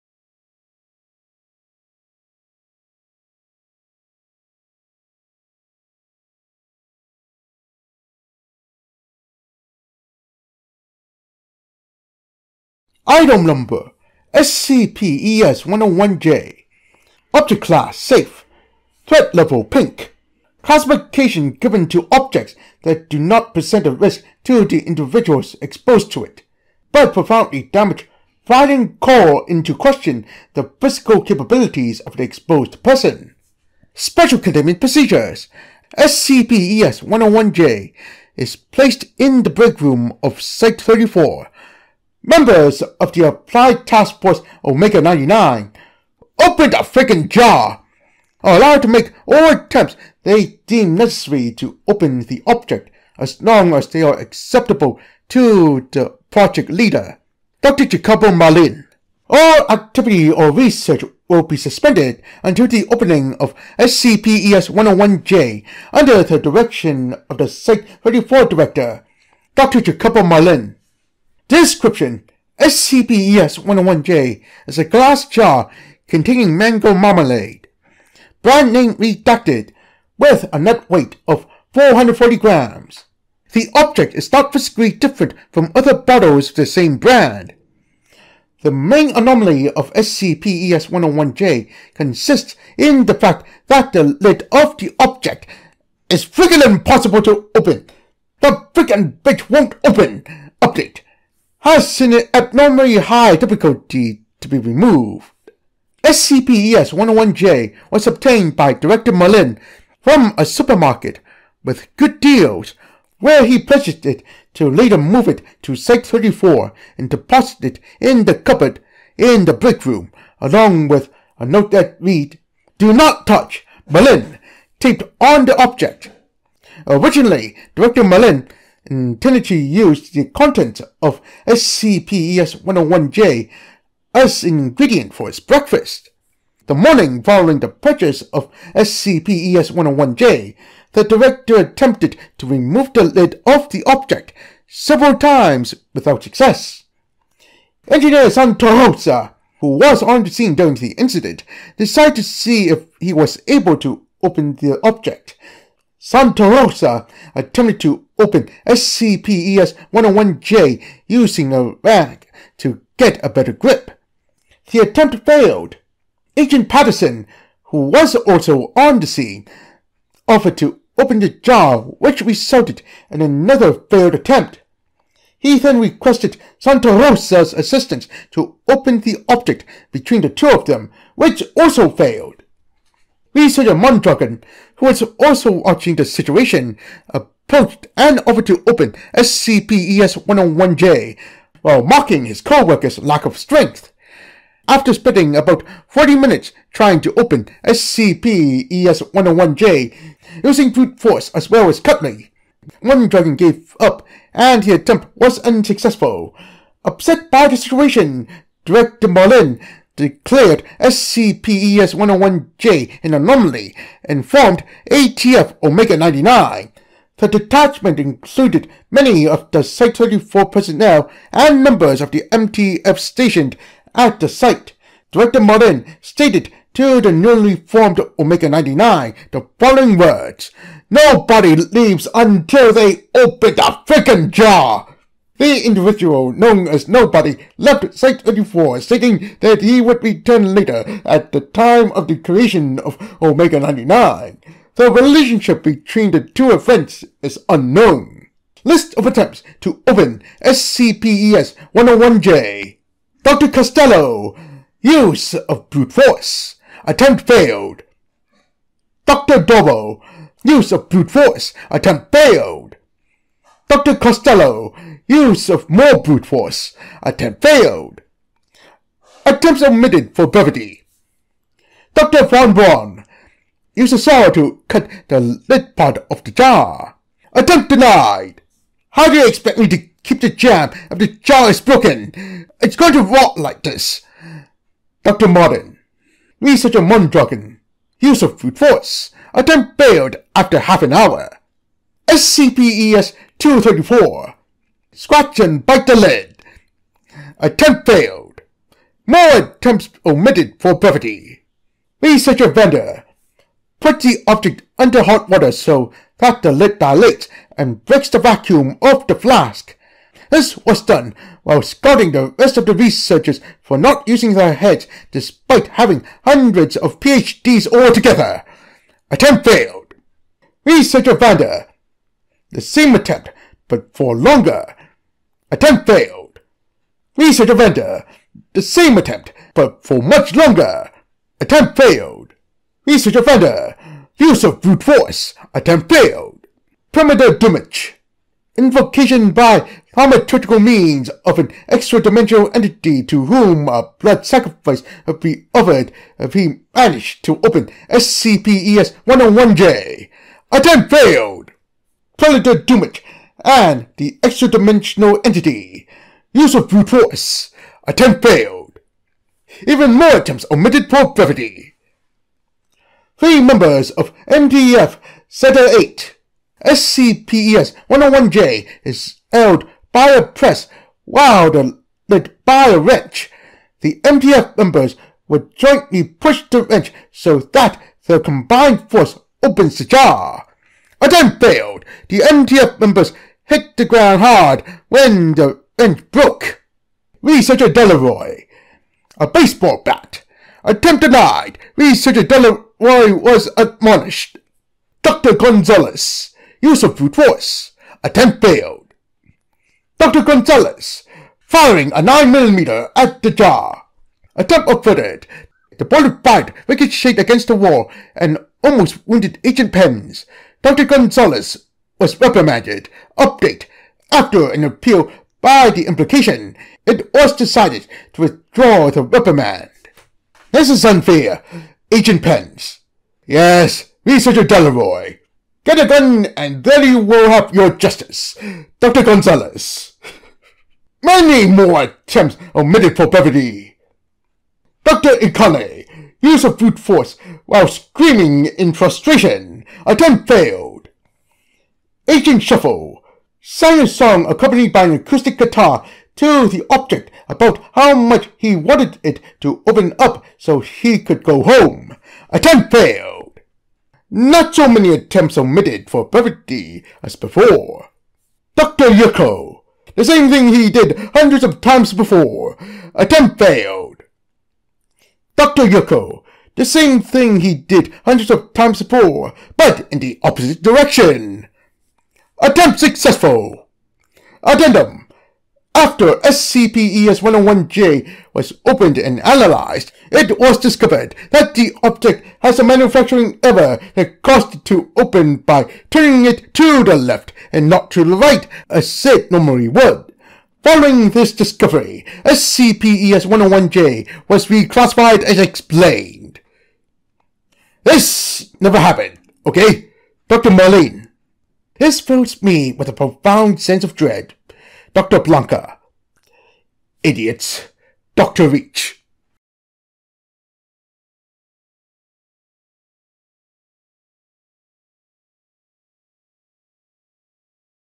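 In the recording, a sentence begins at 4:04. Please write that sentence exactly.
The relationship between the two events is unknown.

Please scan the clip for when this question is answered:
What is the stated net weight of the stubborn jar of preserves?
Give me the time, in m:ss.
1:21.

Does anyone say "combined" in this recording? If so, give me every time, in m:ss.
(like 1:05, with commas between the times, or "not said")
6:18.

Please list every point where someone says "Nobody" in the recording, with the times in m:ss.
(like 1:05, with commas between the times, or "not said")
3:50, 3:56.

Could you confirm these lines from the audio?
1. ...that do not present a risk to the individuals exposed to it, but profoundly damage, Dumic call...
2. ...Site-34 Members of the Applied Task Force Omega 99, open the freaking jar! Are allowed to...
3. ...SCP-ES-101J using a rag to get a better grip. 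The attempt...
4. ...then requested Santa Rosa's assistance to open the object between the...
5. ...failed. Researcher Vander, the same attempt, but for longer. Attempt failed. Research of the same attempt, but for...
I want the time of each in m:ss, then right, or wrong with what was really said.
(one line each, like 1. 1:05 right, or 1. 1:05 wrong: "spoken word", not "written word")
1. 0:22 wrong: "Finding", not "Dumic"
2. 0:40 right
3. 2:38 right
4. 2:55 right
5. 5:19 right.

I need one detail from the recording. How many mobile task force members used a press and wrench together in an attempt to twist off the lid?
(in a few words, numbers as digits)
Three.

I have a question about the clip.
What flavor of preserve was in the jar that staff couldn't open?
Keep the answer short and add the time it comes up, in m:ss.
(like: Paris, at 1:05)
Mango, at 1:16.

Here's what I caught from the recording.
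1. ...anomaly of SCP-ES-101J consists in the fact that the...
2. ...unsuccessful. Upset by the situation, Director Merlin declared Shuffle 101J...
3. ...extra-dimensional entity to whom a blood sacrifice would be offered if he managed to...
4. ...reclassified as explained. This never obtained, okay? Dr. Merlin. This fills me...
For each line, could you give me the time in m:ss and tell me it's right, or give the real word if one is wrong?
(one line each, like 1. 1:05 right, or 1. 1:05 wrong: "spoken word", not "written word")
1. 1:29 right
2. 3:25 wrong: "SCPES", not "Shuffle"
3. 5:41 right
4. 8:14 wrong: "happened", not "obtained".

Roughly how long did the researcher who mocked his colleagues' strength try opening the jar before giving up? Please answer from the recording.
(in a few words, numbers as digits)
40 minutes.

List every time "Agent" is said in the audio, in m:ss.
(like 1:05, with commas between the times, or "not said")
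2:46, 6:49, 7:01, 7:22.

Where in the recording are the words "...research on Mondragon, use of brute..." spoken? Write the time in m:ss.
4:46.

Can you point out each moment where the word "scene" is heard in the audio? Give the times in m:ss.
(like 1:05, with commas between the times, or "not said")
2:30, 2:49.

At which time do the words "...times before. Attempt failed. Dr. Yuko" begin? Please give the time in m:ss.
7:41.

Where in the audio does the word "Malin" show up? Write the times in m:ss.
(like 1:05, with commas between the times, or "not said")
1:49, 2:03, 2:08.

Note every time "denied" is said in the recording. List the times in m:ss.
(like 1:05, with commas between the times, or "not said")
4:37, 6:31.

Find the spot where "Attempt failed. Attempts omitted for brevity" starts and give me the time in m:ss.
4:27.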